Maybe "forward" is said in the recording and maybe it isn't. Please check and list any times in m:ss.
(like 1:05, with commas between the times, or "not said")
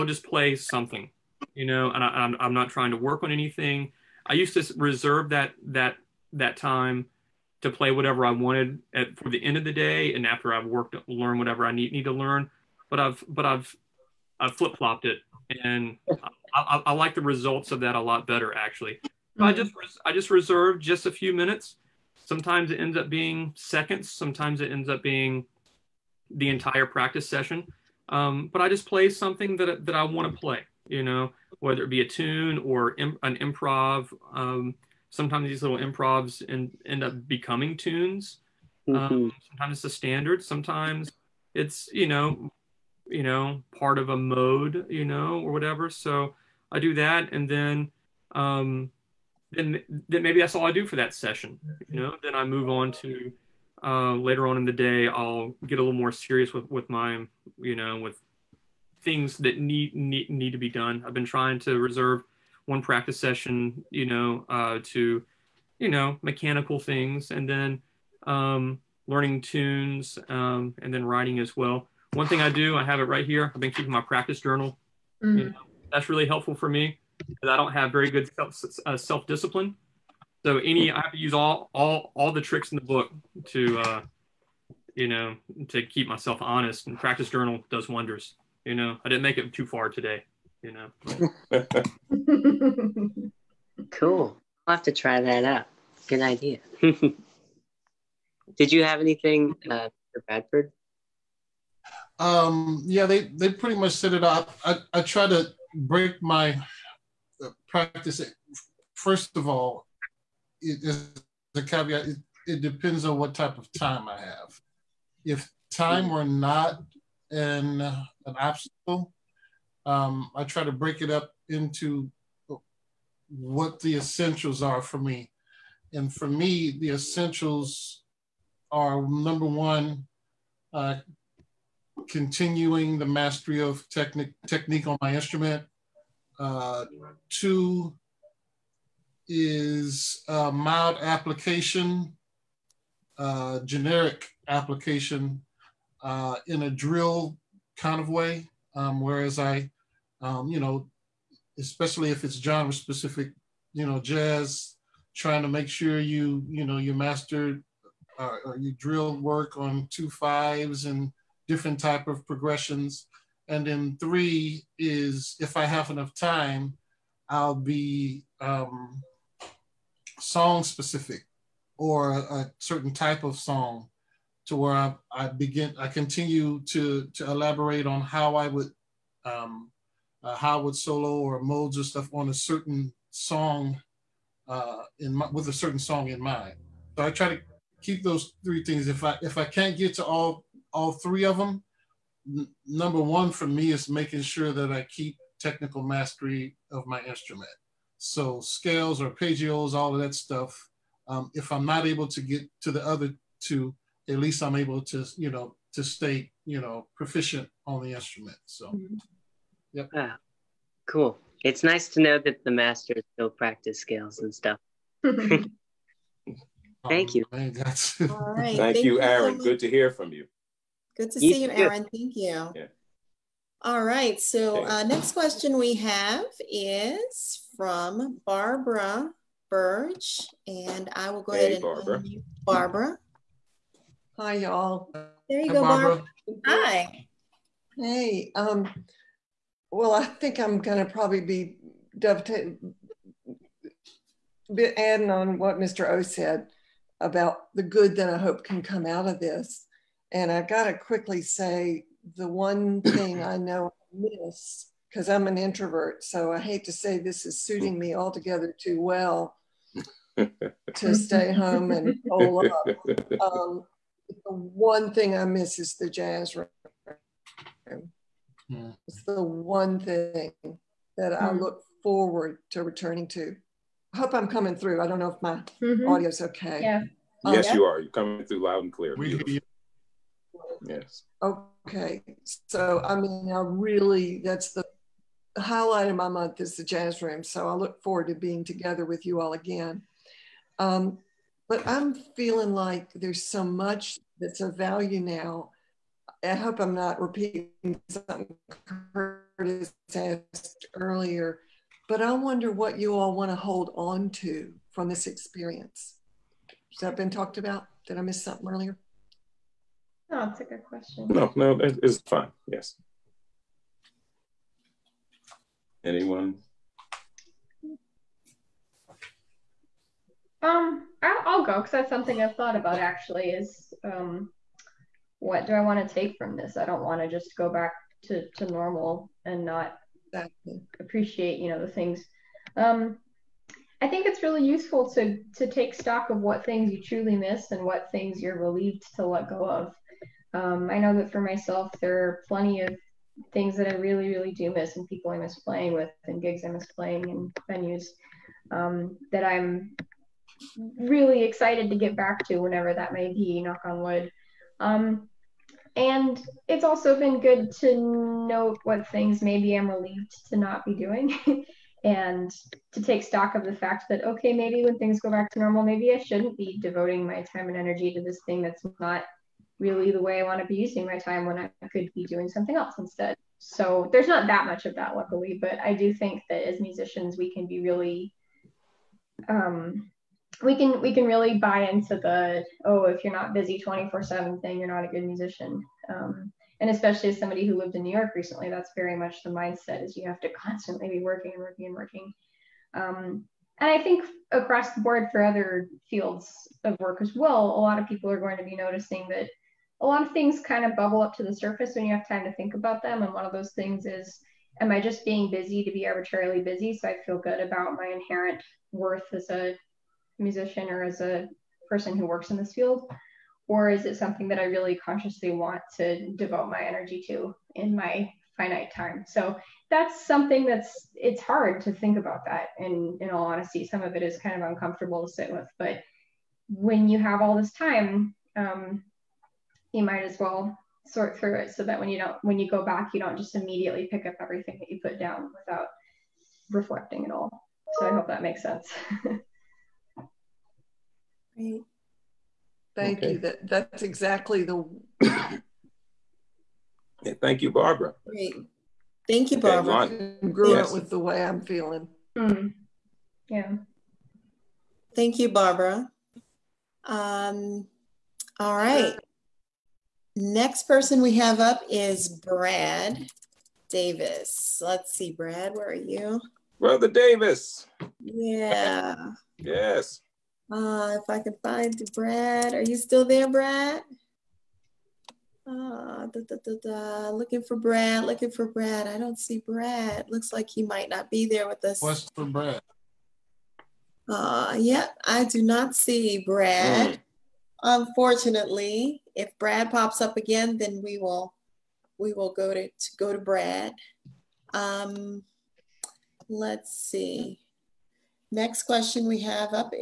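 4:31, 4:47.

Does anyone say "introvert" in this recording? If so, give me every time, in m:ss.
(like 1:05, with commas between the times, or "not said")
4:15.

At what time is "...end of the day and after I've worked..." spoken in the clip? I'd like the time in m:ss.
0:09.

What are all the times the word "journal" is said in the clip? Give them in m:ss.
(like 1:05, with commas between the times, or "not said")
1:14, 1:27.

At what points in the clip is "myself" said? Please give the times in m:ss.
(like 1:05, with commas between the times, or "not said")
1:26, 5:41.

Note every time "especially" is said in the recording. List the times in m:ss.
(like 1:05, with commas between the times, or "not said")
2:31, 6:26.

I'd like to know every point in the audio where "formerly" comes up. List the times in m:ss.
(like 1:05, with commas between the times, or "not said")
not said.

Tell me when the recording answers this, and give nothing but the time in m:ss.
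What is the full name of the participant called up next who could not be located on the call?
7:42.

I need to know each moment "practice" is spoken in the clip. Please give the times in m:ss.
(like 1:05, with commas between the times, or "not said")
0:26, 1:02, 1:14, 1:26, 1:47, 3:33.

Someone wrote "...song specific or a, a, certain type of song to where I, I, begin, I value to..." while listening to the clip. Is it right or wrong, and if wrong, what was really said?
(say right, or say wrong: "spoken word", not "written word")
wrong: "continue", not "value".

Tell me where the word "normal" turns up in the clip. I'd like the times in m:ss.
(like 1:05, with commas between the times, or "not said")
5:28, 6:05.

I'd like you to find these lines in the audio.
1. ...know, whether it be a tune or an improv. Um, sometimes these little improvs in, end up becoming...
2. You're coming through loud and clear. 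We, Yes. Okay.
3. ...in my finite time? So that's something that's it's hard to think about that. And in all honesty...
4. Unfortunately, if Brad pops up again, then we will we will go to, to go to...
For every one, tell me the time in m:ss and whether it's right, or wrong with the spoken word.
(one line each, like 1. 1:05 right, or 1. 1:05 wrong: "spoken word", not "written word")
1. 0:31 right
2. 4:37 right
3. 6:57 right
4. 8:07 right.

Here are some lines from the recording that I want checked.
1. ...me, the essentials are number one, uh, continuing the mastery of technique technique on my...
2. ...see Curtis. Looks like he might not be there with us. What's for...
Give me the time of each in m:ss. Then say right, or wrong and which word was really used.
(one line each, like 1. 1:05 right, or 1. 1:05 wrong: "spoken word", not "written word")
1. 2:06 right
2. 7:59 wrong: "Brad", not "Curtis".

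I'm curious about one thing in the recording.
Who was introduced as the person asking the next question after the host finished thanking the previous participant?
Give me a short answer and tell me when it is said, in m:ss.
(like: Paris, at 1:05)
Barbara Burge, at 3:48.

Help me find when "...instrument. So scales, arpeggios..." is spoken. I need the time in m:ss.
3:17.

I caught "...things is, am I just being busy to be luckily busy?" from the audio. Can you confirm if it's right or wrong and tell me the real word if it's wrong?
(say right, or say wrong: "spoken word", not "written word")
wrong: "arbitrarily", not "luckily".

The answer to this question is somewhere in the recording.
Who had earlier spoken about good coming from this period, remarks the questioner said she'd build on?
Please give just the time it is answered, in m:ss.
4:05.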